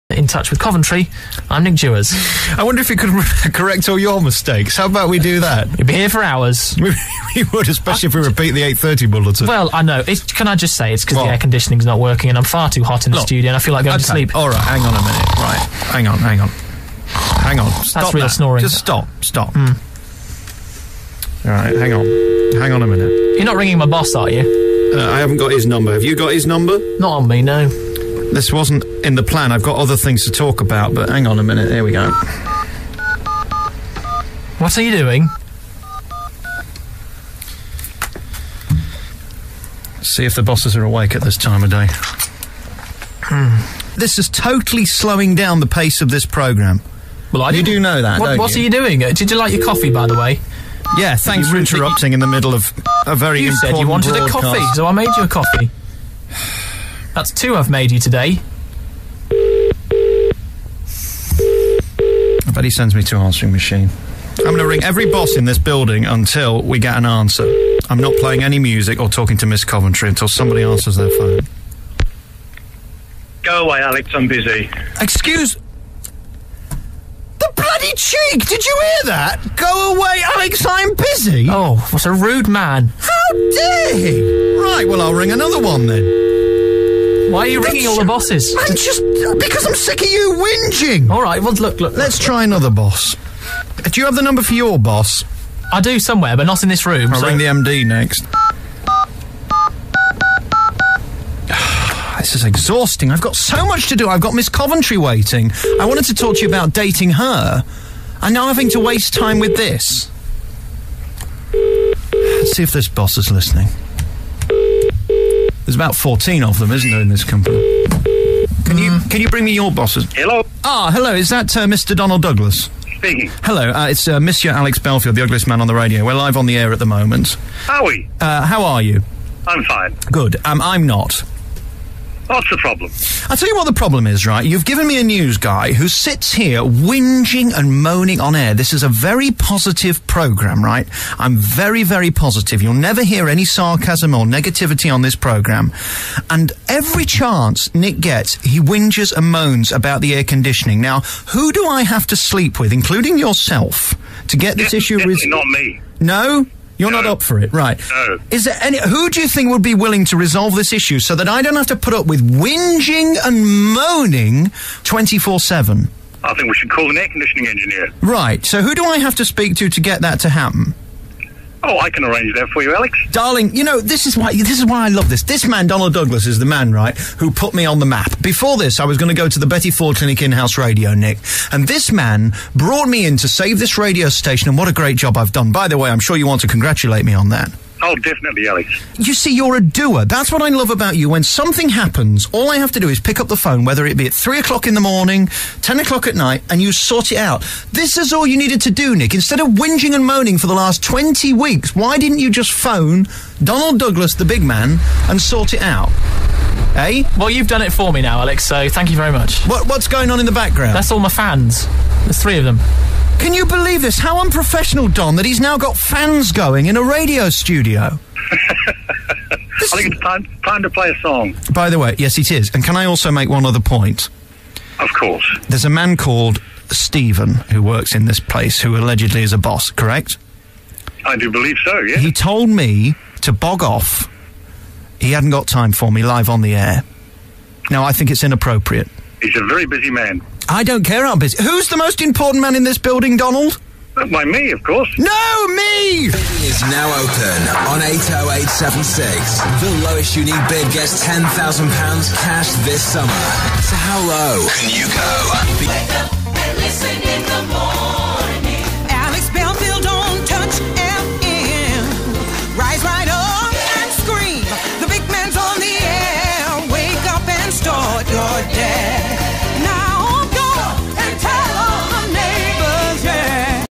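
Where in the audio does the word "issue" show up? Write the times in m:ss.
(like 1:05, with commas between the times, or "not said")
2:34, 2:40.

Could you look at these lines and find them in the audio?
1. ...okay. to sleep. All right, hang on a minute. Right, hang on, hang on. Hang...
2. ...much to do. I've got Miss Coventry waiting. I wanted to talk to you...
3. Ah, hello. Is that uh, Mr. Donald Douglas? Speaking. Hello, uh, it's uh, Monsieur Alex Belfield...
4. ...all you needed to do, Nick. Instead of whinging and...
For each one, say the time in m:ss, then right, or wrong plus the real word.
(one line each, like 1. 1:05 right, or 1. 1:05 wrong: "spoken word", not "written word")
1. 0:13 right
2. 1:43 right
3. 2:00 right
4. 3:18 right.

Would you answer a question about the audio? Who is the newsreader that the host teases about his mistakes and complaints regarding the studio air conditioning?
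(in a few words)
Nick Jewers.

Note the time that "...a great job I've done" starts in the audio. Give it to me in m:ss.
3:04.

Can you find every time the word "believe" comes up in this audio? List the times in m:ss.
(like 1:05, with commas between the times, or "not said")
3:33, 3:51.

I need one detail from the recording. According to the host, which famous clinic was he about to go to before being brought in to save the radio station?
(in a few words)
Betty Ford Clinic.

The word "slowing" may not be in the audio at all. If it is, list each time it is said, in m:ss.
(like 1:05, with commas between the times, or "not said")
0:44.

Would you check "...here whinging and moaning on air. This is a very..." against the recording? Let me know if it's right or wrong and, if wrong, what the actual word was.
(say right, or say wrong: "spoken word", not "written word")
right.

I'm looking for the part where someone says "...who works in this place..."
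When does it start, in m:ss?
3:47.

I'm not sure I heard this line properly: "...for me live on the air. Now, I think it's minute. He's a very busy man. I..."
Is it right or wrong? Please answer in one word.
wrong.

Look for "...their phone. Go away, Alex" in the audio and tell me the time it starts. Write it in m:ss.
1:10.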